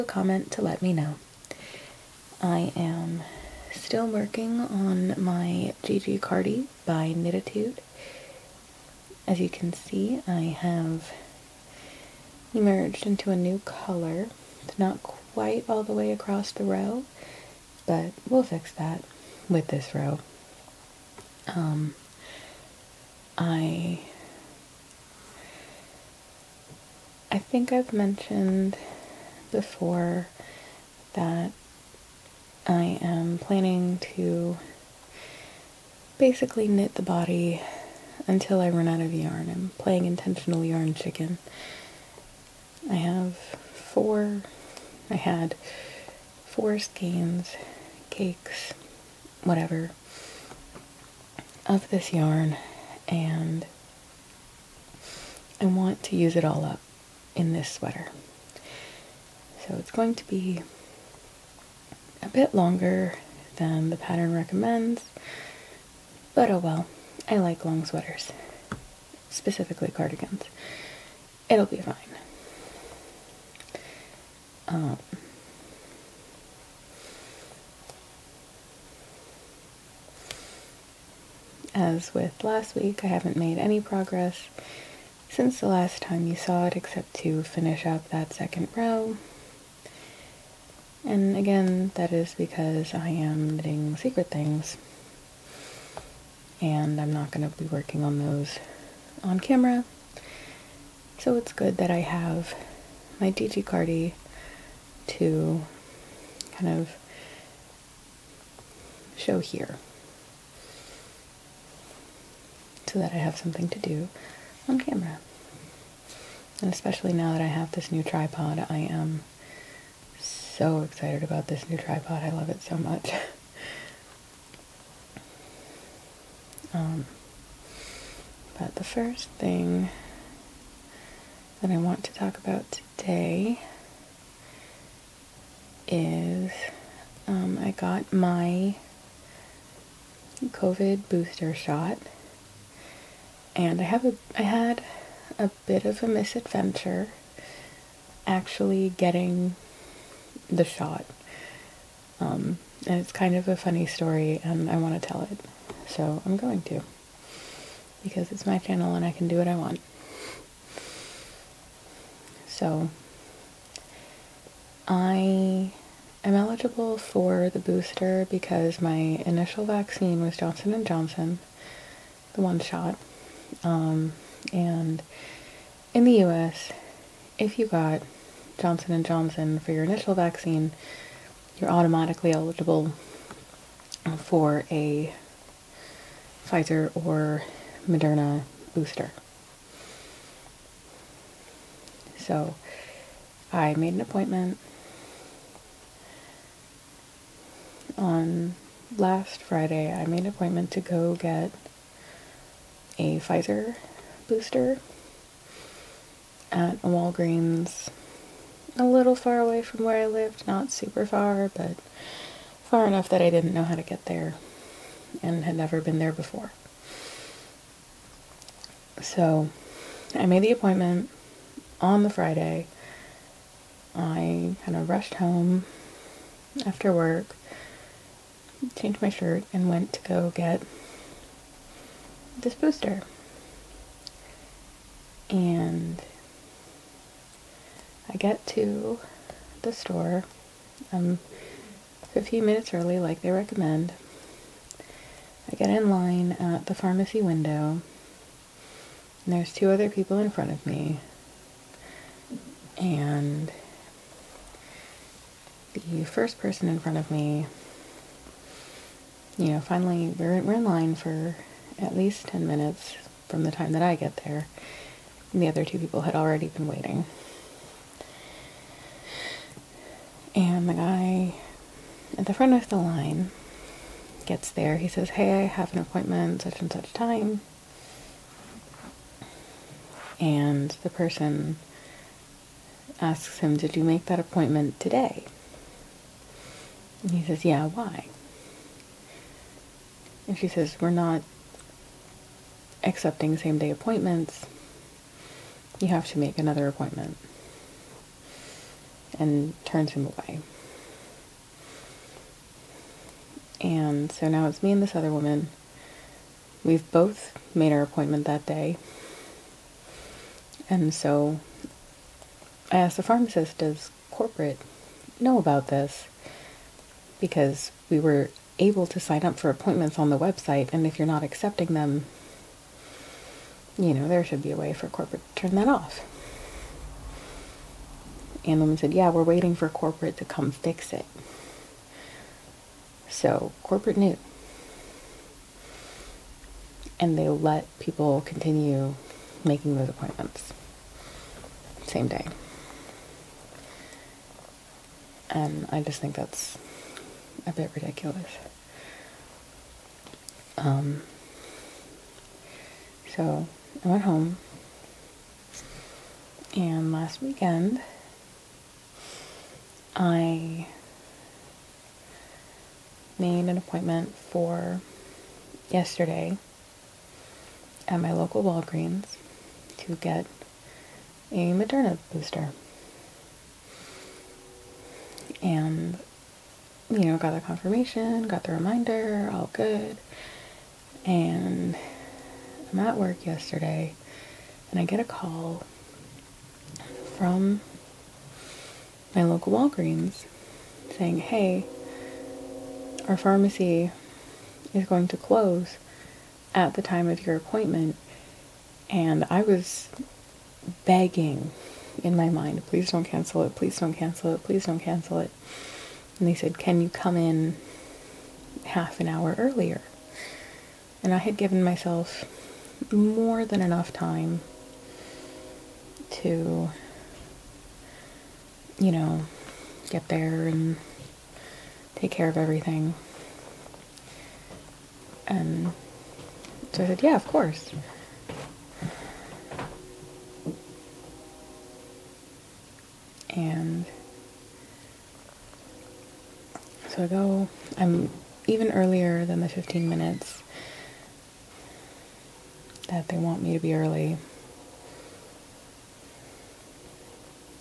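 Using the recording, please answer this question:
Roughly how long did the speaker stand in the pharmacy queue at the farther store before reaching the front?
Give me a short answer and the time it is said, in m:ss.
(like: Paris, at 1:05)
10 minutes, at 4:22.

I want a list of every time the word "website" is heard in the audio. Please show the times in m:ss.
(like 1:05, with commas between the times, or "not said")
5:20.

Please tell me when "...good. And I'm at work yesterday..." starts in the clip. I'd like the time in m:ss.
6:19.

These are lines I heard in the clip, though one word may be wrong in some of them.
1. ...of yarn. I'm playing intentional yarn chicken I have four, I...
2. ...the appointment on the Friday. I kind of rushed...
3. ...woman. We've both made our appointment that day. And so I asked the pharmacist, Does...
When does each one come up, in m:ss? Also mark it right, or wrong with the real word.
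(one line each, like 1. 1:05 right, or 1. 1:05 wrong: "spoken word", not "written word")
1. 0:39 right
2. 3:40 right
3. 5:05 right.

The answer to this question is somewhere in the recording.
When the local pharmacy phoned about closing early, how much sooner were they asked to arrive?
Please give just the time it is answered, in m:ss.
6:48.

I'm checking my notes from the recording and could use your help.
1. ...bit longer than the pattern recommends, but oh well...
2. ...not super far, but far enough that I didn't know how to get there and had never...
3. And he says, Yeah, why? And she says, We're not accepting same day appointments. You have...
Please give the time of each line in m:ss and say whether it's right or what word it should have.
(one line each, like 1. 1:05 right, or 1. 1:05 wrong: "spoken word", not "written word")
1. 1:02 right
2. 3:30 right
3. 4:47 right.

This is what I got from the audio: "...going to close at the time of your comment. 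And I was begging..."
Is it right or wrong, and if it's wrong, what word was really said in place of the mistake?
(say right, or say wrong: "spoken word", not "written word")
wrong: "appointment", not "comment".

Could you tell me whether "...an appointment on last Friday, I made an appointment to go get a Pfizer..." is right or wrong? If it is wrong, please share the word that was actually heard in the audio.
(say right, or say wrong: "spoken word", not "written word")
right.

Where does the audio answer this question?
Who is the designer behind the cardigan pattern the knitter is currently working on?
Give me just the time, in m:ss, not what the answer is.
0:07.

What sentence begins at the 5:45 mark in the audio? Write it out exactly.
And I just think that's a bit ridiculous.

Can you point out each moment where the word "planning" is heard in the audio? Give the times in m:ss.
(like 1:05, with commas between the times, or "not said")
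0:33.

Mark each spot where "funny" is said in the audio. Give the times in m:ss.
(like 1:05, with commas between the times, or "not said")
2:33.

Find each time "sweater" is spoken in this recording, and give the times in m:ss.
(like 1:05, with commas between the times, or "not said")
0:57, 1:07.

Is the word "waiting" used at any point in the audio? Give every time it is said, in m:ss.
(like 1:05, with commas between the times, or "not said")
4:26, 5:29.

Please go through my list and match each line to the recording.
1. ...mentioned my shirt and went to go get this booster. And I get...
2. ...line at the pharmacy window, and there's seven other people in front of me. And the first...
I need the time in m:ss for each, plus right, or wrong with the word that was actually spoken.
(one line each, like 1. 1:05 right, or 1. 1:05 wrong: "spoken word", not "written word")
1. 3:48 wrong: "changed", not "mentioned"
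2. 4:05 wrong: "two", not "seven".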